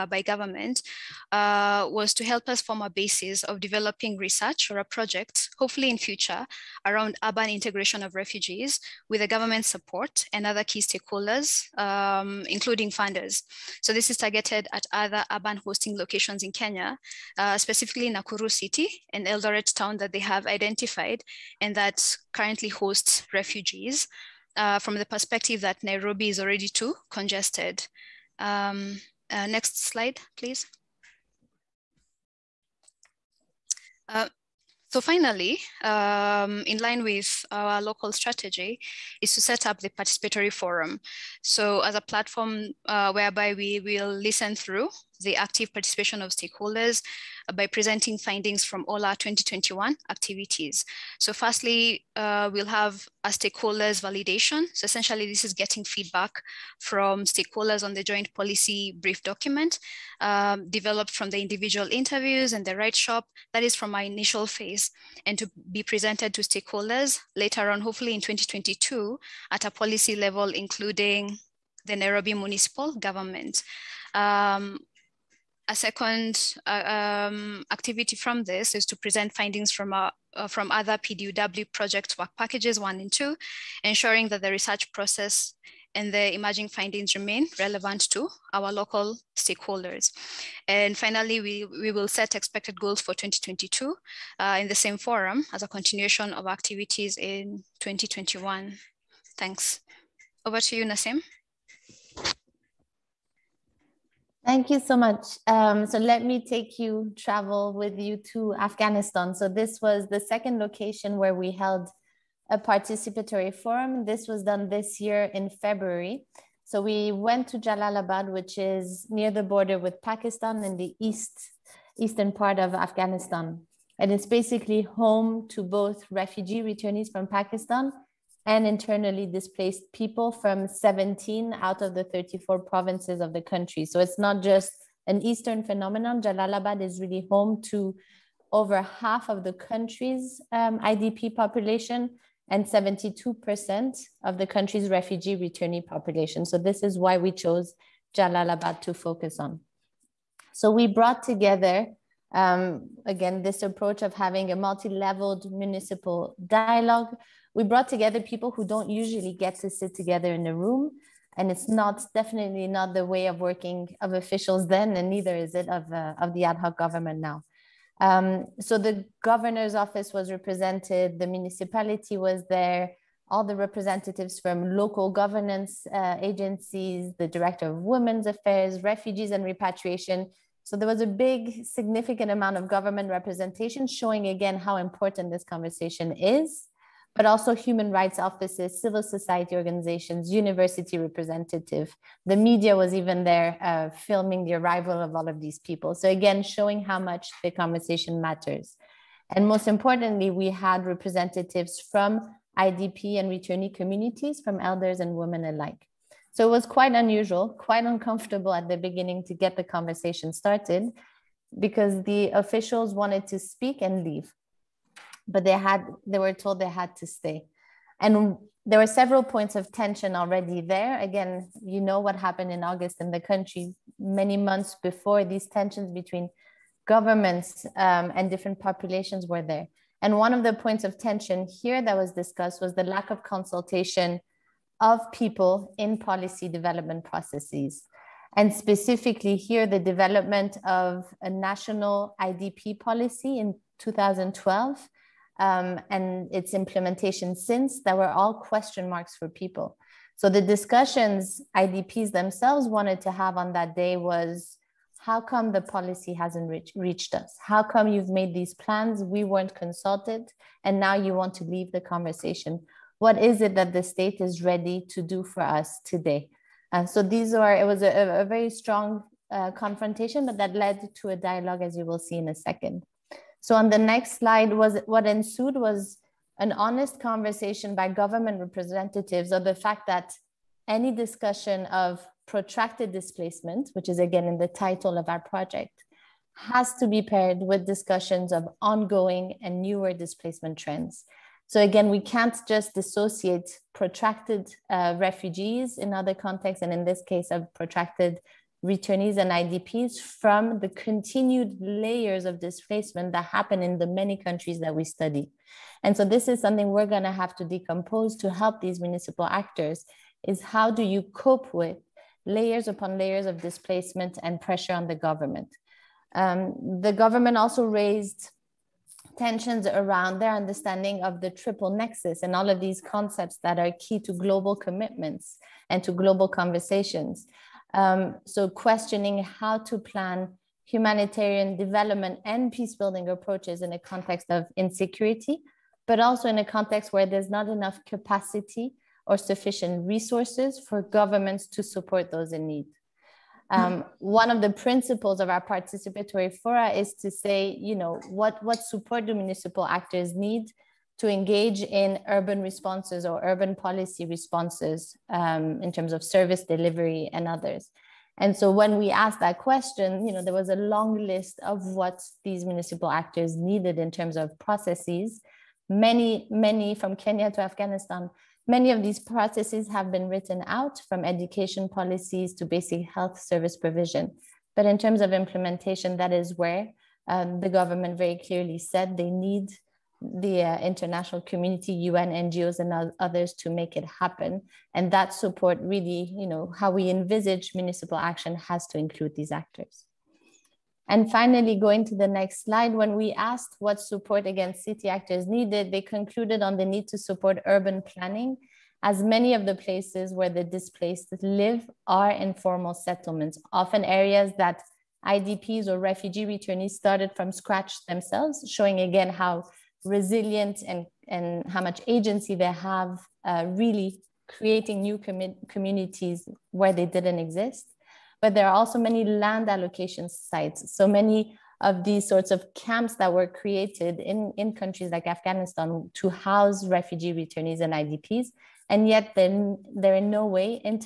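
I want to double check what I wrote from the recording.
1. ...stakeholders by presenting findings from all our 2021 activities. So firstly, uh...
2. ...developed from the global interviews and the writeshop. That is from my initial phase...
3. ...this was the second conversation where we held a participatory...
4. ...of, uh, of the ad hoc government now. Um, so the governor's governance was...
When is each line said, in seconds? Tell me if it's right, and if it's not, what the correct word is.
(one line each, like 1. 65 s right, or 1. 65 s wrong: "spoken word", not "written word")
1. 46 s right
2. 60 s wrong: "individual", not "global"
3. 109 s wrong: "location", not "conversation"
4. 165 s wrong: "office", not "governance".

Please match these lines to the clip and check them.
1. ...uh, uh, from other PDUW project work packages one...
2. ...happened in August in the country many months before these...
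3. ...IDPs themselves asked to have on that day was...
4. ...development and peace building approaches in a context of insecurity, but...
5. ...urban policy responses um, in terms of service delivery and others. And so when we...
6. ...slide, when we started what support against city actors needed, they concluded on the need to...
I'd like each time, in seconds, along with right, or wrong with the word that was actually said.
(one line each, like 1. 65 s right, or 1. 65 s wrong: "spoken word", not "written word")
1. 80 s right
2. 222 s right
3. 251 s wrong: "wanted", not "asked"
4. 331 s right
5. 353 s right
6. 392 s wrong: "asked", not "started".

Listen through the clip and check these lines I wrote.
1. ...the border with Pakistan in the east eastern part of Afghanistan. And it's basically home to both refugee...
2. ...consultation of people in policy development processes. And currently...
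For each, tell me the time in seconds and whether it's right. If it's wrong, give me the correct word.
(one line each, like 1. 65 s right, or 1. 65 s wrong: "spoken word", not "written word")
1. 119 s right
2. 233 s wrong: "specifically", not "currently".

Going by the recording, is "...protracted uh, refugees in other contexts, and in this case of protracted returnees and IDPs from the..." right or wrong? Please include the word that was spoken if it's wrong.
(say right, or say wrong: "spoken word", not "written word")
right.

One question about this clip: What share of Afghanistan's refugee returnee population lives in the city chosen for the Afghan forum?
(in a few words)
72%.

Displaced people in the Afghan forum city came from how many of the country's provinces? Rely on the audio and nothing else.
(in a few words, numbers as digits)
17.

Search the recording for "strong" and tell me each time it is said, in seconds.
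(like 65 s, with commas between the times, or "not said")
268 s.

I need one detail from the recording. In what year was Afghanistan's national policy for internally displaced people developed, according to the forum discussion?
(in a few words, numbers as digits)
2012.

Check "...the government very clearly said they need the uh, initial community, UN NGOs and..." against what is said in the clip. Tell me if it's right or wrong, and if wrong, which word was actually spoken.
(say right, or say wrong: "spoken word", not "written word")
wrong: "international", not "initial".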